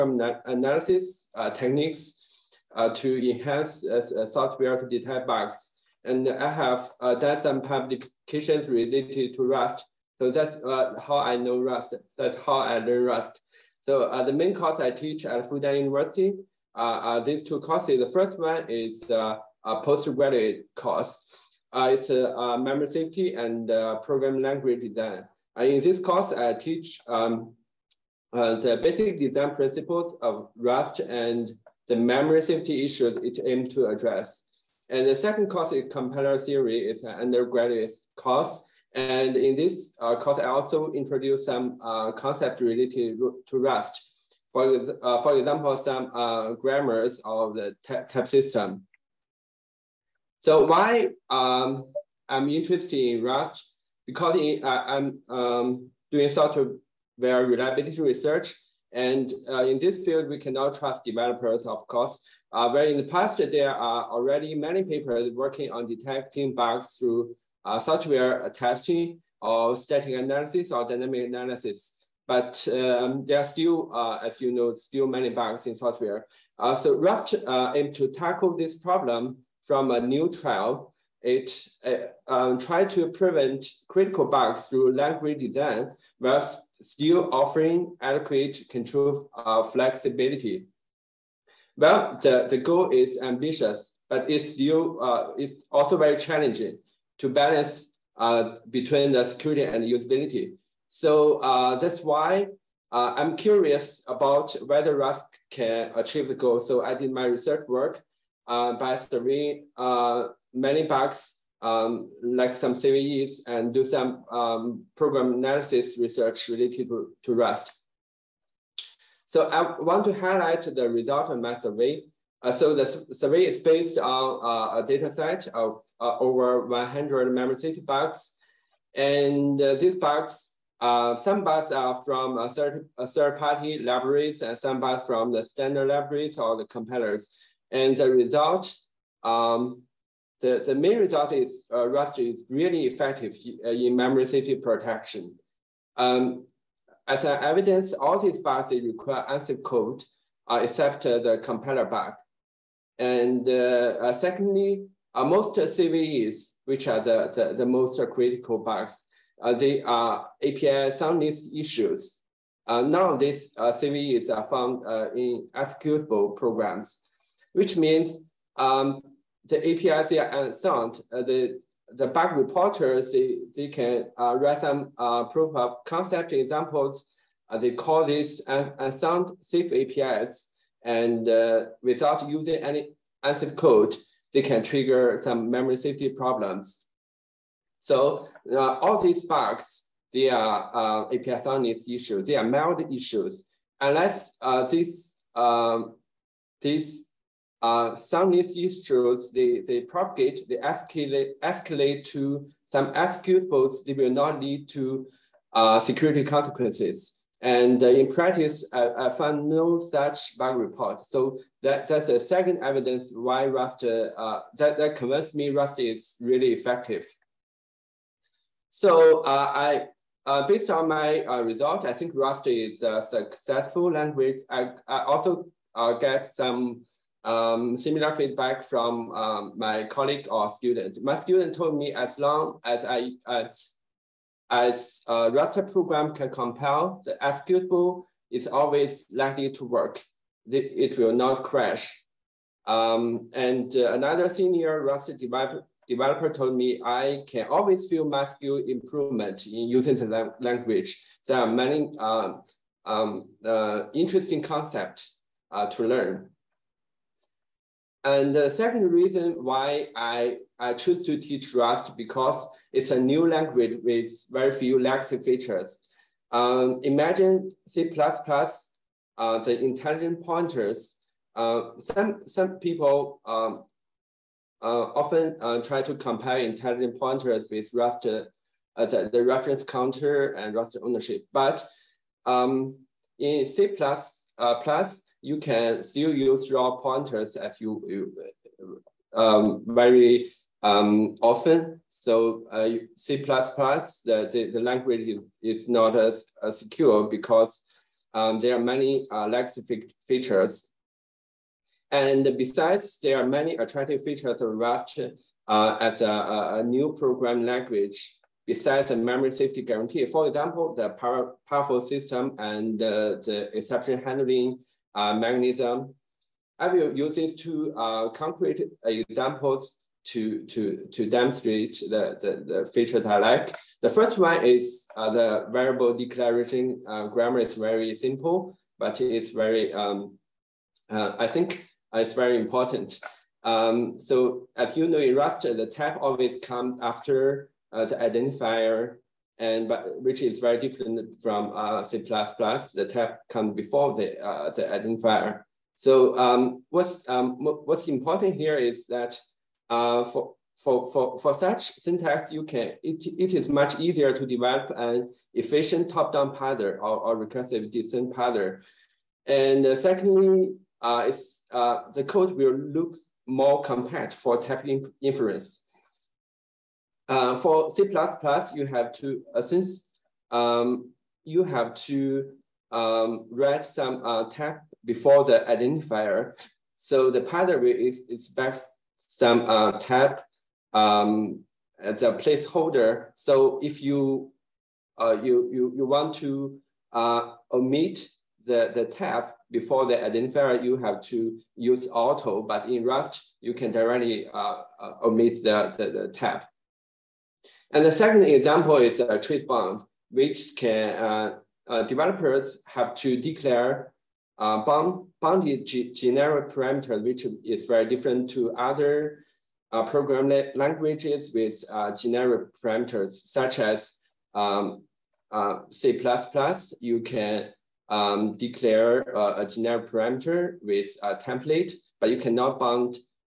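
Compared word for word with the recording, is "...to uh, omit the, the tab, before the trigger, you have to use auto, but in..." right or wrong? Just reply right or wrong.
wrong.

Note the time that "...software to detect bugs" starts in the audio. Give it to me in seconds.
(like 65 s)
4 s.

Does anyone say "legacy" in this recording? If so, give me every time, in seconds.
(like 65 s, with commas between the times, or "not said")
264 s, 299 s.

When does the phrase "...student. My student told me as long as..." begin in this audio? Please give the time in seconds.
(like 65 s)
230 s.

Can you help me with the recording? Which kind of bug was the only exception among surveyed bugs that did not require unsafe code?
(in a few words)
Compiler bug.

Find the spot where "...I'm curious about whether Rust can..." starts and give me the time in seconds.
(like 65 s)
103 s.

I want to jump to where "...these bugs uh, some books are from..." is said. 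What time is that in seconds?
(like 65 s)
129 s.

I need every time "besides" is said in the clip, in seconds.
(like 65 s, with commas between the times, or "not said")
302 s, 308 s.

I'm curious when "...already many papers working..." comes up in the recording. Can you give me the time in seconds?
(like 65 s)
64 s.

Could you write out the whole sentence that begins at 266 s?
Um, imagine C++, uh, the intelligent pointers.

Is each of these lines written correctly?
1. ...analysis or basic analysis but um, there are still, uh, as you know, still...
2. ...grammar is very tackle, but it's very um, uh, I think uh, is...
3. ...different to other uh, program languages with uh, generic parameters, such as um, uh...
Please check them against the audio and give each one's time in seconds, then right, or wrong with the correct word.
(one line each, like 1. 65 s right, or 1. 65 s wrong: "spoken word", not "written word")
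1. 70 s wrong: "dynamic", not "basic"
2. 327 s wrong: "simple", not "tackle"
3. 407 s right.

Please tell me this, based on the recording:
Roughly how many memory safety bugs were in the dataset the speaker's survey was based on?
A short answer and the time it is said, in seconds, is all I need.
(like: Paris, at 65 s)
Over 100, at 126 s.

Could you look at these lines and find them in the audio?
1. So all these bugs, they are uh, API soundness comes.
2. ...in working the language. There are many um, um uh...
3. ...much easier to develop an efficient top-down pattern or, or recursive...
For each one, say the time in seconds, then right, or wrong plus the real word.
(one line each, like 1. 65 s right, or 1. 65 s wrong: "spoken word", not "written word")
1. 187 s wrong: "issues", not "comes"
2. 249 s wrong: "using", not "working"
3. 353 s right.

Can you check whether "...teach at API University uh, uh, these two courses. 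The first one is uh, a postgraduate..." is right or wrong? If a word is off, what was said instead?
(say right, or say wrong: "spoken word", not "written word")
wrong: "Fudan", not "API".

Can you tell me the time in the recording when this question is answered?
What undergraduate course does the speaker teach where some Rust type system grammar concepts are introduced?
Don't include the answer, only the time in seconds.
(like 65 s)
35 s.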